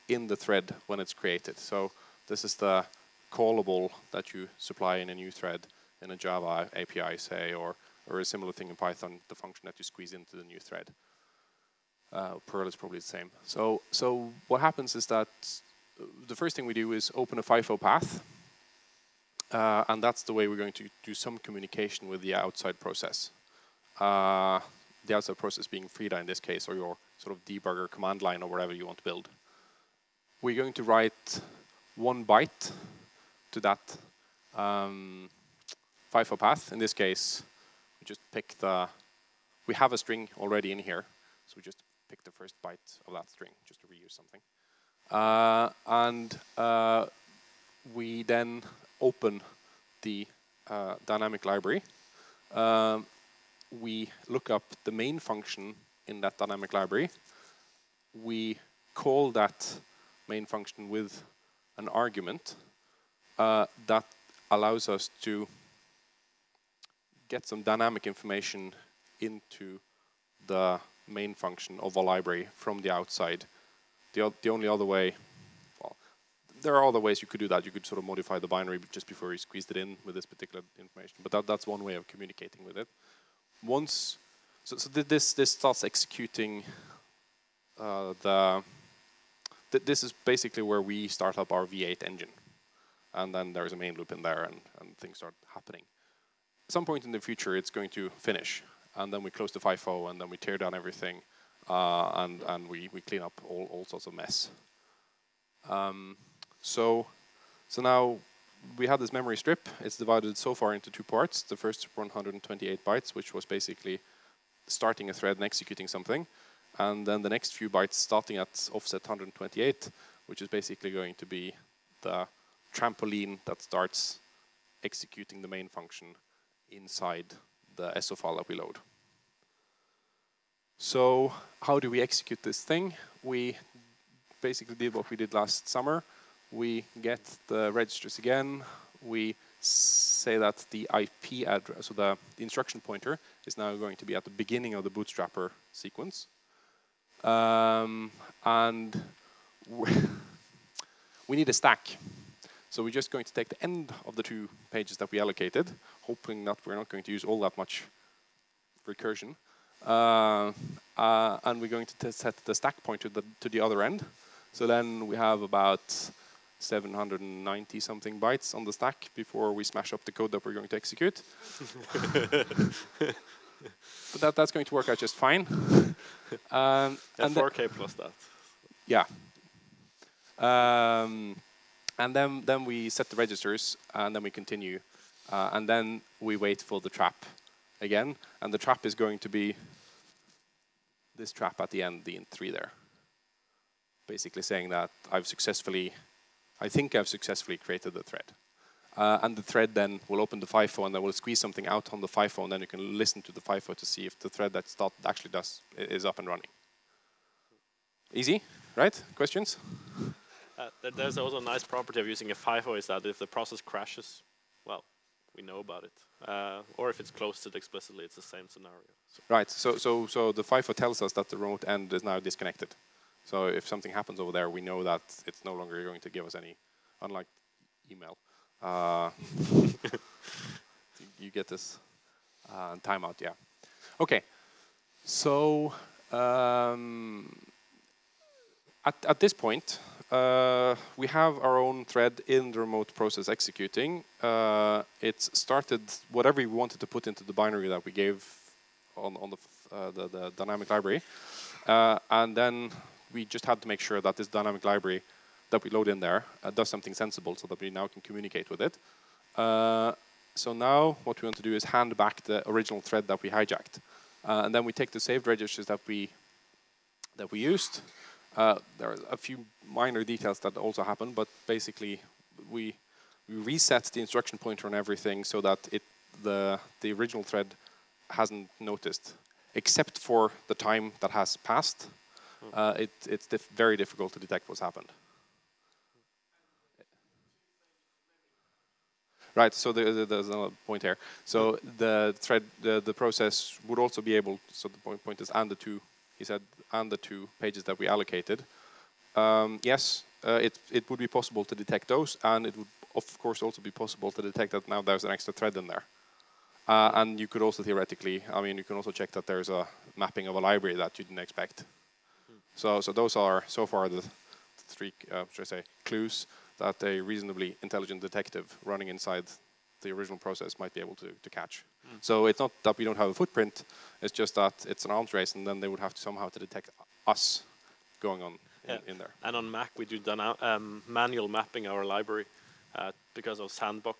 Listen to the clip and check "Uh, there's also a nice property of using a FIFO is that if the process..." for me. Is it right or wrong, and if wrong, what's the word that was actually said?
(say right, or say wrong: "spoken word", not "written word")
right.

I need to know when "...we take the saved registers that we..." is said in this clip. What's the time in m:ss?
4:24.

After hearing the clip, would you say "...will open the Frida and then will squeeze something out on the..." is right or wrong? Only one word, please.
wrong.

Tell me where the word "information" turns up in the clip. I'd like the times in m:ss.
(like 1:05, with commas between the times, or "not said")
1:08, 1:20.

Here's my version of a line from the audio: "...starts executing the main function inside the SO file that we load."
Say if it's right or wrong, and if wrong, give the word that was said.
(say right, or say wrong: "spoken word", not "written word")
right.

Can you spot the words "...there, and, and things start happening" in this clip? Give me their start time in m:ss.
1:34.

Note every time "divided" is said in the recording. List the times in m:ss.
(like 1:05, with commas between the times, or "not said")
1:49.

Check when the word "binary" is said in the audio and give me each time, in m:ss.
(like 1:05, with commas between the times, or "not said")
1:18, 4:07.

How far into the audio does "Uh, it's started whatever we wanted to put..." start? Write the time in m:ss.
4:04.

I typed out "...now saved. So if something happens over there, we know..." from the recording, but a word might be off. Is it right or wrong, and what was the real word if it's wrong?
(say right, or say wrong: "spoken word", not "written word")
wrong: "disconnected", not "saved".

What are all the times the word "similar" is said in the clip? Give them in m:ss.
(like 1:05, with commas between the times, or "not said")
0:08.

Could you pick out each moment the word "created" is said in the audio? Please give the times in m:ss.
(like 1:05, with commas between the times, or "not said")
0:01, 3:17.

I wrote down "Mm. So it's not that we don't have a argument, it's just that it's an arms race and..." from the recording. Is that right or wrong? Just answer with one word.
wrong.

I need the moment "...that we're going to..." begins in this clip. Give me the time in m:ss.
2:50.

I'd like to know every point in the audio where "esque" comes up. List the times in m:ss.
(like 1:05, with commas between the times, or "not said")
not said.